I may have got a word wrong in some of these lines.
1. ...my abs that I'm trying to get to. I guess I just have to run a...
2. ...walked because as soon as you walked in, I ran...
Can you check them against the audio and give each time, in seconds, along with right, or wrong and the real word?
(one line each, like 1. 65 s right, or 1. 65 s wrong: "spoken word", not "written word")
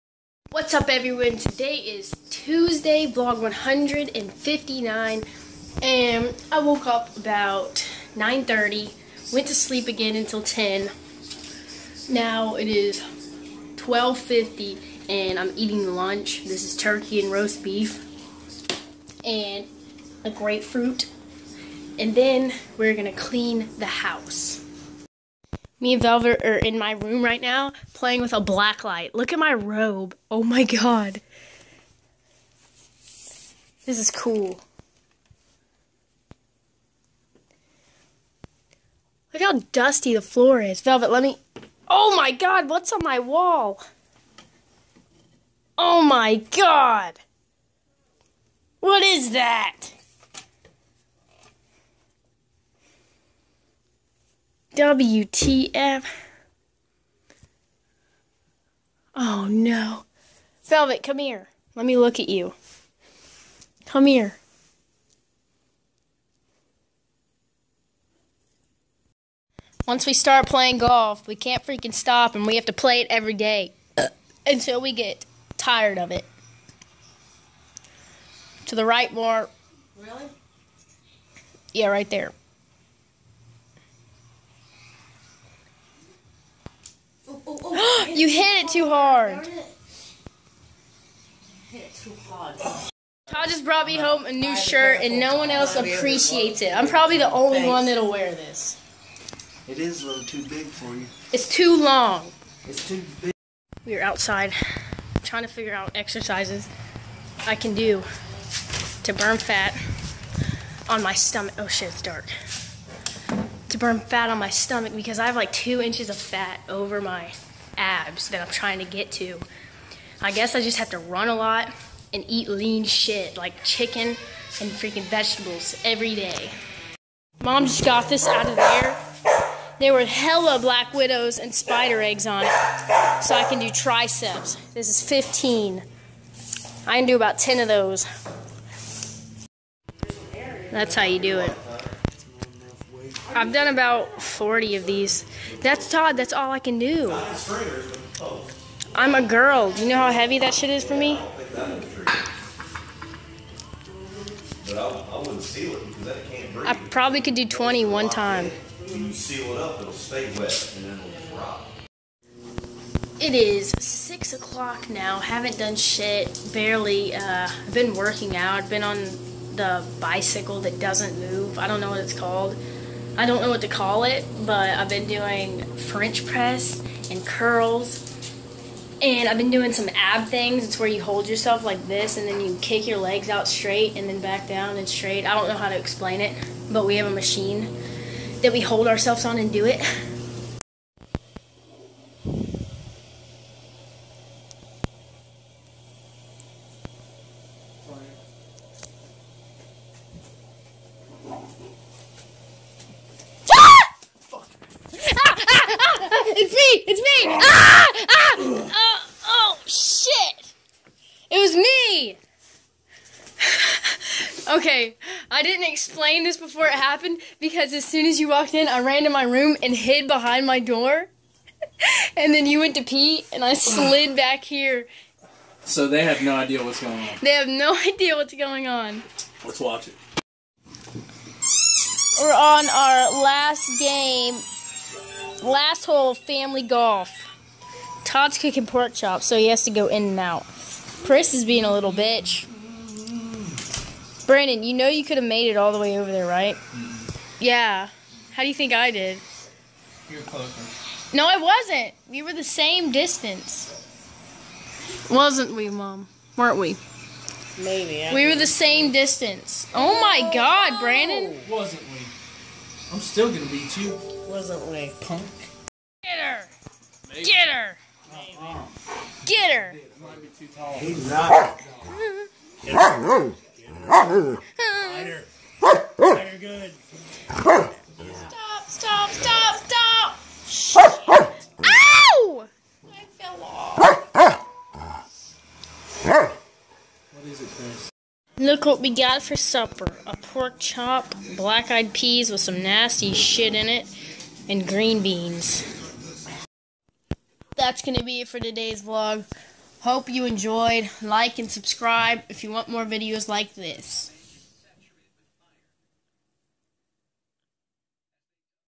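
1. 116 s right
2. 216 s wrong: "happened", not "walked".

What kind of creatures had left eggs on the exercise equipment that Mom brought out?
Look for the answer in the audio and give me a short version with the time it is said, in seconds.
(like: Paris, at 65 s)
Black widows, at 130 s.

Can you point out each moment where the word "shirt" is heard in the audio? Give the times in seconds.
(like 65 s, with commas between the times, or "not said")
94 s.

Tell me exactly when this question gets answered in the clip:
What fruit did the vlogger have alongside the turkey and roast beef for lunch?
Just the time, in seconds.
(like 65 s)
20 s.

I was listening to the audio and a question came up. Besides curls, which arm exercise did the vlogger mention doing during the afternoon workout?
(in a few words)
French press.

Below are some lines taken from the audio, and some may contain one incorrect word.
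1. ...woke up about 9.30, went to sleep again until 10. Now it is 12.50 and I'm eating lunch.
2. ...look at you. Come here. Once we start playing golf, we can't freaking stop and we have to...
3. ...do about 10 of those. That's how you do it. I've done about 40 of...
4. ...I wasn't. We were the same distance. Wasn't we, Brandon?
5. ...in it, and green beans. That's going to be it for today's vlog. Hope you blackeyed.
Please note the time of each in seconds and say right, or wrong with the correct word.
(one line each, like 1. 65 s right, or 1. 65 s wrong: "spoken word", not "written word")
1. 6 s right
2. 61 s right
3. 137 s right
4. 251 s wrong: "Mom", not "Brandon"
5. 293 s wrong: "enjoyed", not "blackeyed".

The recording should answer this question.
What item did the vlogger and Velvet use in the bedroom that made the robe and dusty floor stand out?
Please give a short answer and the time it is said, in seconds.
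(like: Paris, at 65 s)
Black light, at 28 s.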